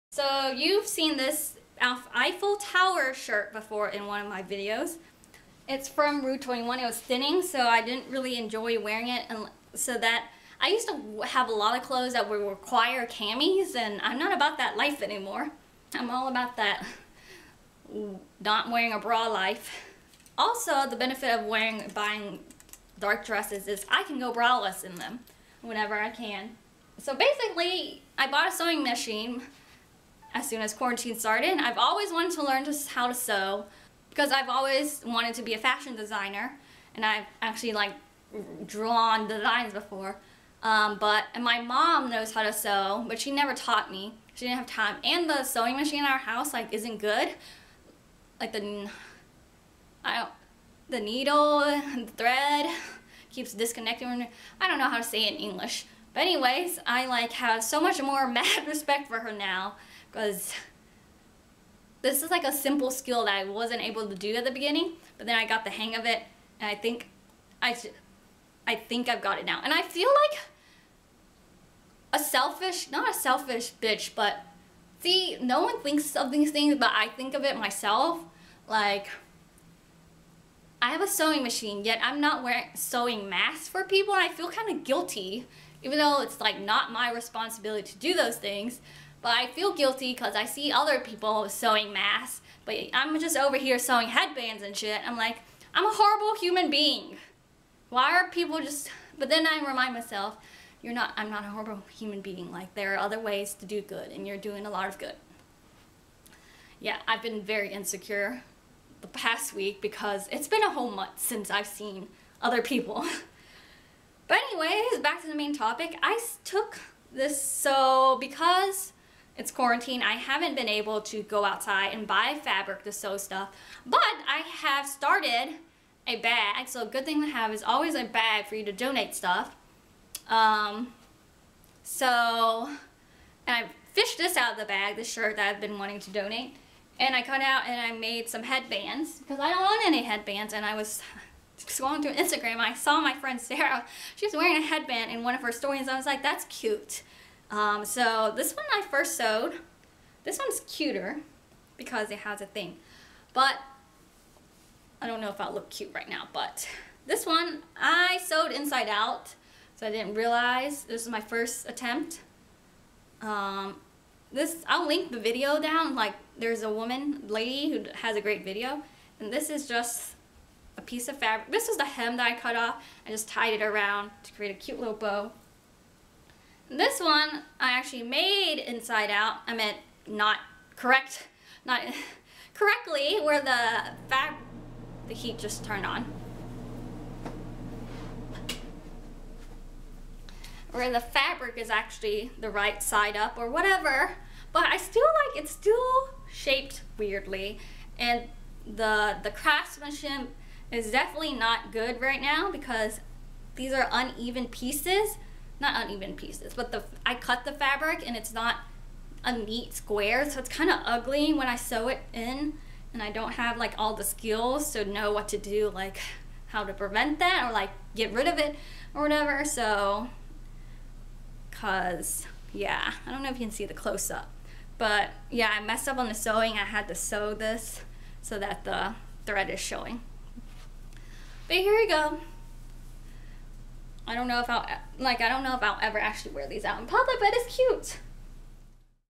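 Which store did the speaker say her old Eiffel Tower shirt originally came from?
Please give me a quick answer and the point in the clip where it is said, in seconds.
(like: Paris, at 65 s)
Rue 21, at 6 s.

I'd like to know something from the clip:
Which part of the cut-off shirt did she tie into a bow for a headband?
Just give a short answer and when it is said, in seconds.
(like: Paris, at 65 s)
the hem, at 171 s.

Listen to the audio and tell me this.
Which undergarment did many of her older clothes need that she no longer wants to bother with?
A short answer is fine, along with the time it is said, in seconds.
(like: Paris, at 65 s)
camis, at 13 s.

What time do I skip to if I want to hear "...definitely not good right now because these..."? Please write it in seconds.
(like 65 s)
200 s.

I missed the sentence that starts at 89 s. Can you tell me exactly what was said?
But I feel guilty because I see other people sewing masks, but I'm just over here sewing headbands and shit.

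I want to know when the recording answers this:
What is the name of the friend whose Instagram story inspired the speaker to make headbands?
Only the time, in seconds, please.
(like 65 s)
143 s.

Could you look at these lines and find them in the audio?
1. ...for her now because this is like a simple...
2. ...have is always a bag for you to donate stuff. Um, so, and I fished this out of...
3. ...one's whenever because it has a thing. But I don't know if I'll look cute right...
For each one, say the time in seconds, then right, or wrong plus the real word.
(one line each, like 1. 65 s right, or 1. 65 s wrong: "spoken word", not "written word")
1. 59 s right
2. 127 s right
3. 150 s wrong: "cuter", not "whenever".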